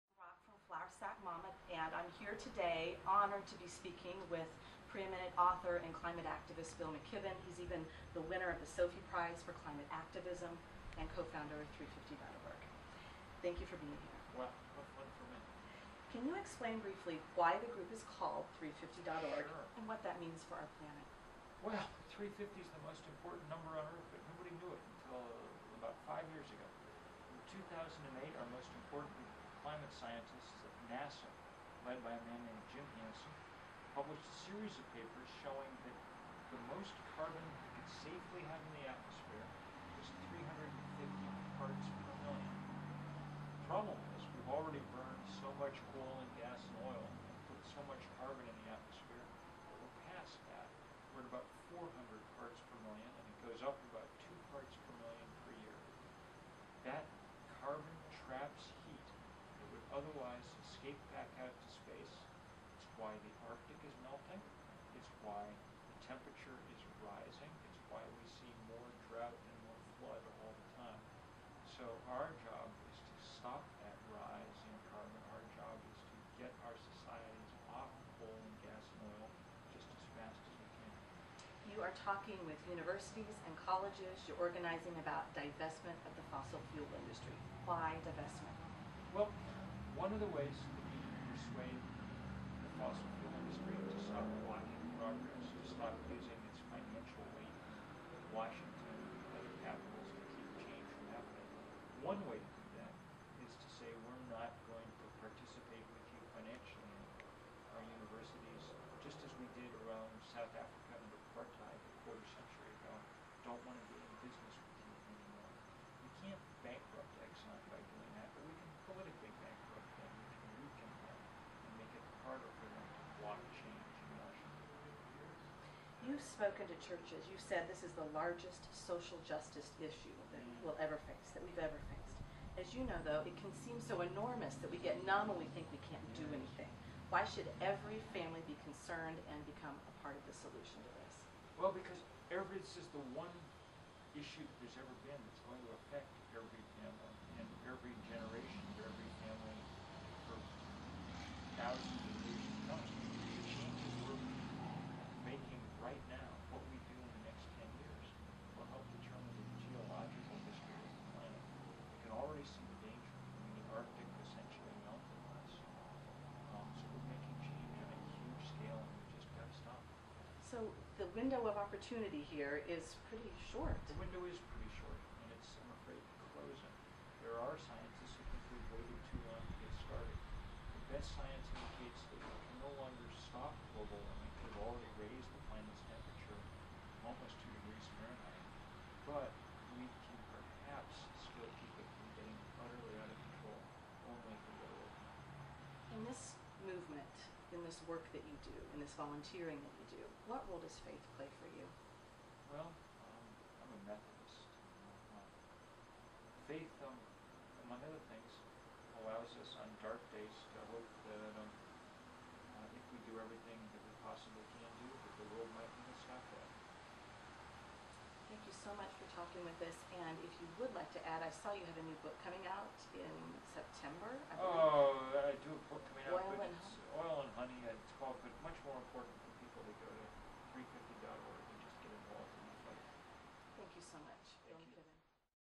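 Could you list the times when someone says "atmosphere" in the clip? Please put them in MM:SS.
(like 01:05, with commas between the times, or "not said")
00:38, 00:48.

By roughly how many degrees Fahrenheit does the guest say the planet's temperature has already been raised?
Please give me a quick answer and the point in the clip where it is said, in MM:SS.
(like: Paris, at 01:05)
2 degrees, at 03:07.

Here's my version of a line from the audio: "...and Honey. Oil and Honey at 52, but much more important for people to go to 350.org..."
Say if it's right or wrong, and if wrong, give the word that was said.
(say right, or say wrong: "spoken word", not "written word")
wrong: "12", not "52".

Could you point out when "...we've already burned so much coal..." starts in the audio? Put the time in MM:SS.
00:44.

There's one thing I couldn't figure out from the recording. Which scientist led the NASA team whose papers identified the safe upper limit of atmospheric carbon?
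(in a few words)
Jim Hansen.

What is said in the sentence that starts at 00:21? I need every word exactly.
Well, 350 is the most important number on Earth, but nobody knew it until about five years ago.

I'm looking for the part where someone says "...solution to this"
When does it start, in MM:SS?
02:20.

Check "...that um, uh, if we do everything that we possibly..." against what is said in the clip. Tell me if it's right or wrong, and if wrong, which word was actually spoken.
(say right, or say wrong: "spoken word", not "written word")
right.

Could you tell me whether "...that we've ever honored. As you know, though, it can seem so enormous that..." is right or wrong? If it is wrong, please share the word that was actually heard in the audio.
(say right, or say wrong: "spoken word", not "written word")
wrong: "faced", not "honored".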